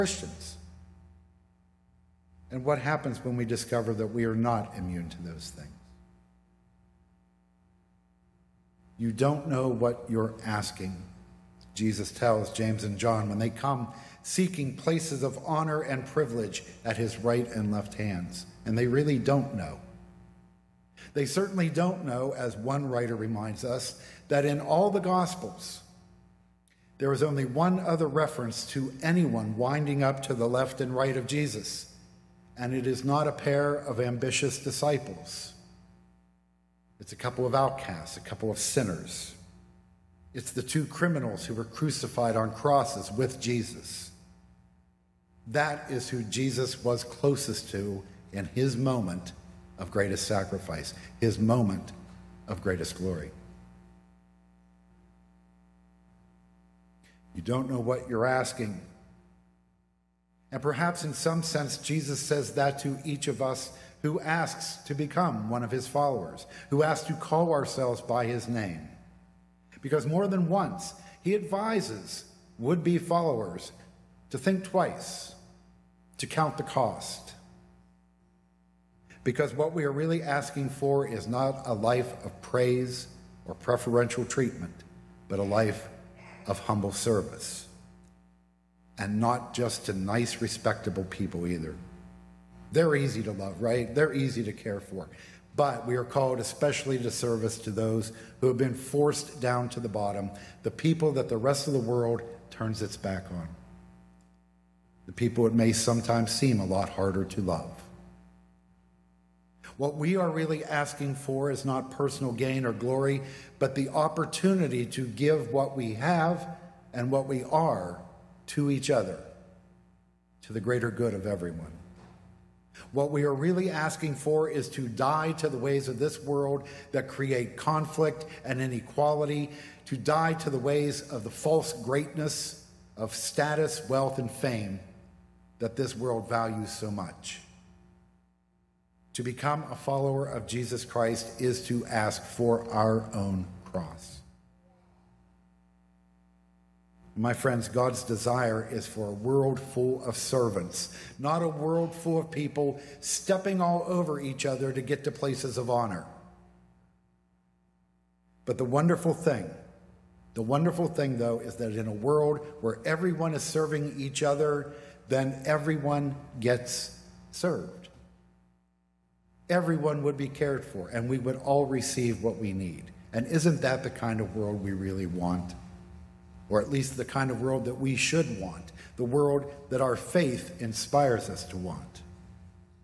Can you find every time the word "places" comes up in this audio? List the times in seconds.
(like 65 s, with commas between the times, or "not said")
14 s, 155 s.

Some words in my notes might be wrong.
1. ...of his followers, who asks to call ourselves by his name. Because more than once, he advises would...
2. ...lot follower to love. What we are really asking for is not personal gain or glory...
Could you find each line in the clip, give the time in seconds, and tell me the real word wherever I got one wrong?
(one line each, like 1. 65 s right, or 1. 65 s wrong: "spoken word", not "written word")
1. 65 s right
2. 106 s wrong: "harder", not "follower".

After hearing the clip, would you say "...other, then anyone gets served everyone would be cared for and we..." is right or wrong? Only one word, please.
wrong.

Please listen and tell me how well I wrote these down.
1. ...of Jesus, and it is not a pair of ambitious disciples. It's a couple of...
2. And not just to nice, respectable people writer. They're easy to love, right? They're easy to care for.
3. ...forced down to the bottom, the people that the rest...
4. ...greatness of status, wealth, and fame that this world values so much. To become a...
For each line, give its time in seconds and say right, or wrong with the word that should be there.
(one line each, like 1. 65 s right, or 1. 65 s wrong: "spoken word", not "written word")
1. 31 s right
2. 88 s wrong: "either", not "writer"
3. 98 s right
4. 131 s right.